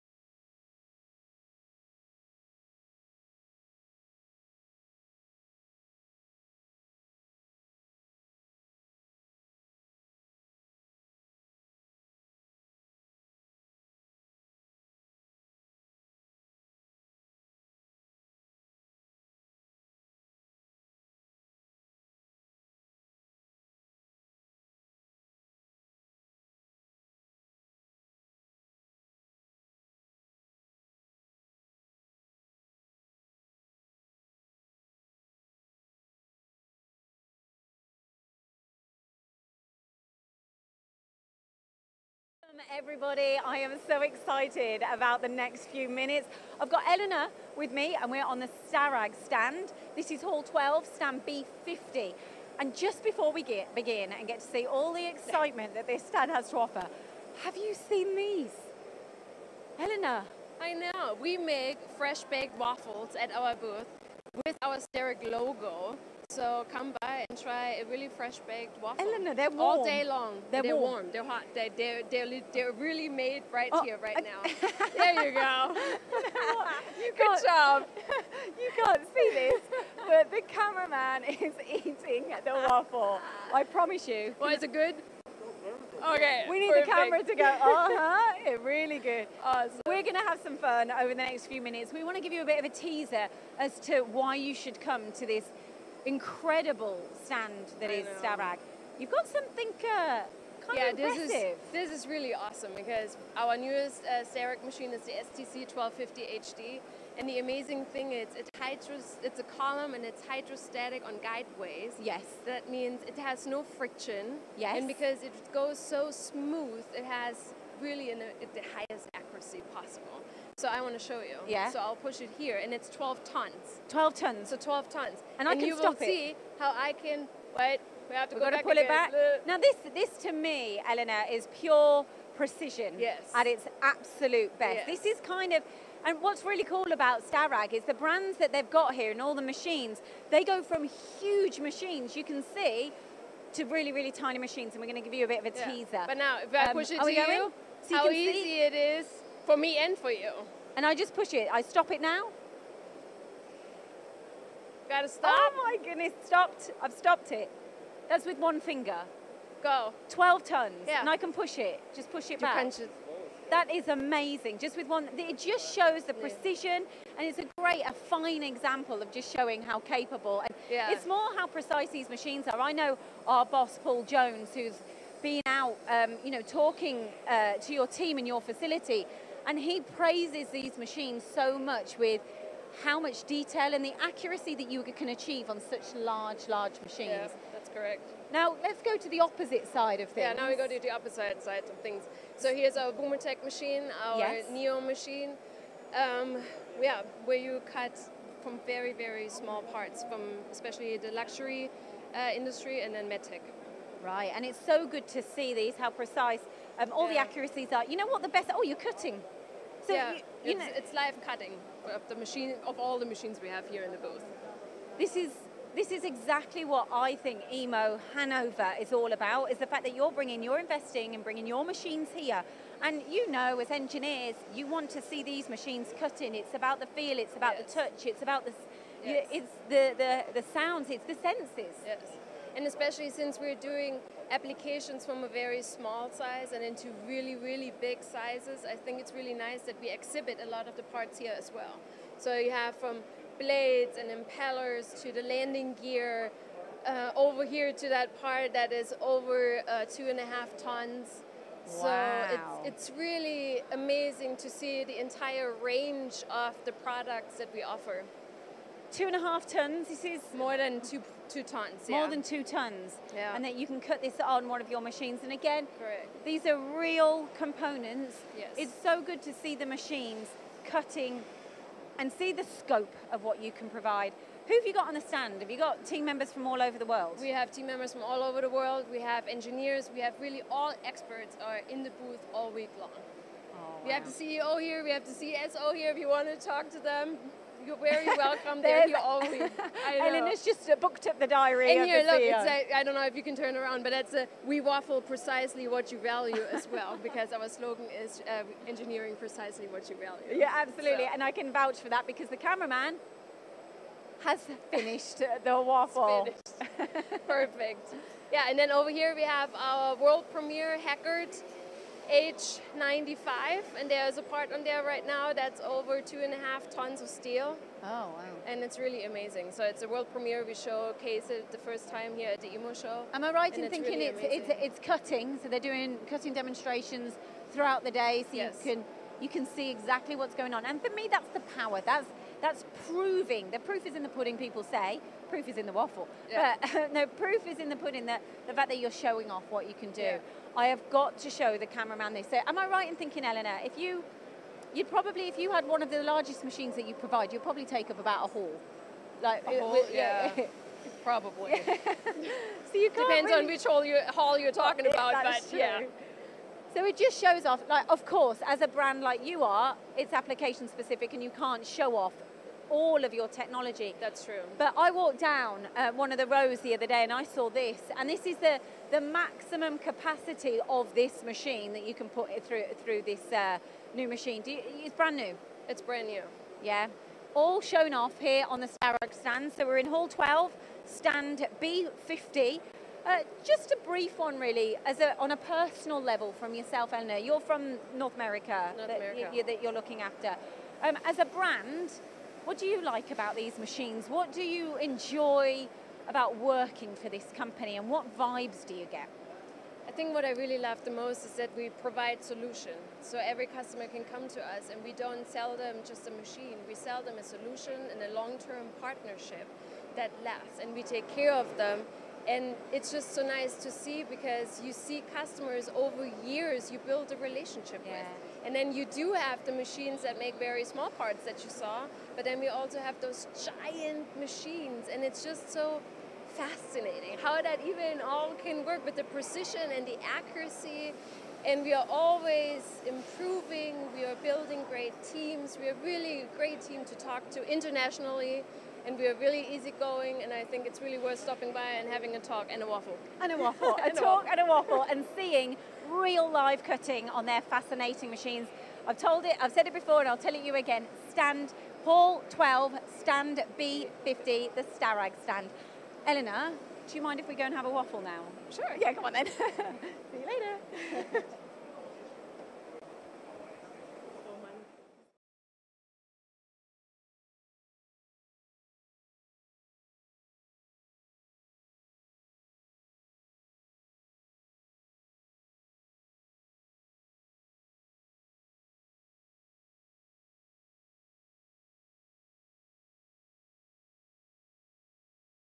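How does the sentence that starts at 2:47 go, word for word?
and it's a great, a fine example of just showing how capable.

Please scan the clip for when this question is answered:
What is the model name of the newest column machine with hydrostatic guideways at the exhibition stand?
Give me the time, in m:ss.
1:45.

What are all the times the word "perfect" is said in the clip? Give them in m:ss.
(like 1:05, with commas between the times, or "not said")
1:26, 5:07.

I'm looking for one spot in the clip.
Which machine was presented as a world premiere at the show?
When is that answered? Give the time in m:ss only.
5:10.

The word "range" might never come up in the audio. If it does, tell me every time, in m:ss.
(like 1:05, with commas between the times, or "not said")
4:15.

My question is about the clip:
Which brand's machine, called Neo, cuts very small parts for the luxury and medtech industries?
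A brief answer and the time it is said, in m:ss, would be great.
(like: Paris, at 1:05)
Bumotec, at 3:12.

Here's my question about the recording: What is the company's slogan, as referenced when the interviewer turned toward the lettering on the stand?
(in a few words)
Engineering precisely what you value.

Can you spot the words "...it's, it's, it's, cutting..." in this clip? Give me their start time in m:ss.
5:24.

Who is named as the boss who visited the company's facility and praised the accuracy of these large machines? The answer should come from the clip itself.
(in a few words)
Paul Jones.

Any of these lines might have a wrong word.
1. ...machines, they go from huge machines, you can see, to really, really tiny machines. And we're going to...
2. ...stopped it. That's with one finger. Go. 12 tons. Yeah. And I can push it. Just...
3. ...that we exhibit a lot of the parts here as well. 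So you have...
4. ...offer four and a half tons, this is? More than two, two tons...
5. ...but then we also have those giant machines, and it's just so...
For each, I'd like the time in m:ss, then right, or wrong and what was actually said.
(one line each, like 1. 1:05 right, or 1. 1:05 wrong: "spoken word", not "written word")
1. 2:19 right
2. 2:36 right
3. 3:59 right
4. 4:17 wrong: "two", not "four"
5. 7:02 right.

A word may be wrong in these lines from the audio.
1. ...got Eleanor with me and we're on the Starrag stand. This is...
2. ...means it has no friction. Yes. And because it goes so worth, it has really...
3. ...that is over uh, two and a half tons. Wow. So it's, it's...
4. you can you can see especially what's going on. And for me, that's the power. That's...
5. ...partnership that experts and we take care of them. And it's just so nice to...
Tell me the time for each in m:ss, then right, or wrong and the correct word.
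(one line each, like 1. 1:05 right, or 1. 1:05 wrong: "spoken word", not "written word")
1. 0:46 right
2. 1:52 wrong: "smooth", not "worth"
3. 4:08 right
4. 5:28 wrong: "exactly", not "especially"
5. 6:48 wrong: "lasts", not "experts".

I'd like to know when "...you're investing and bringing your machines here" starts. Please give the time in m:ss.
3:40.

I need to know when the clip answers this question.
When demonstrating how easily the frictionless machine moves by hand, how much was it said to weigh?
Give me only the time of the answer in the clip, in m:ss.
2:02.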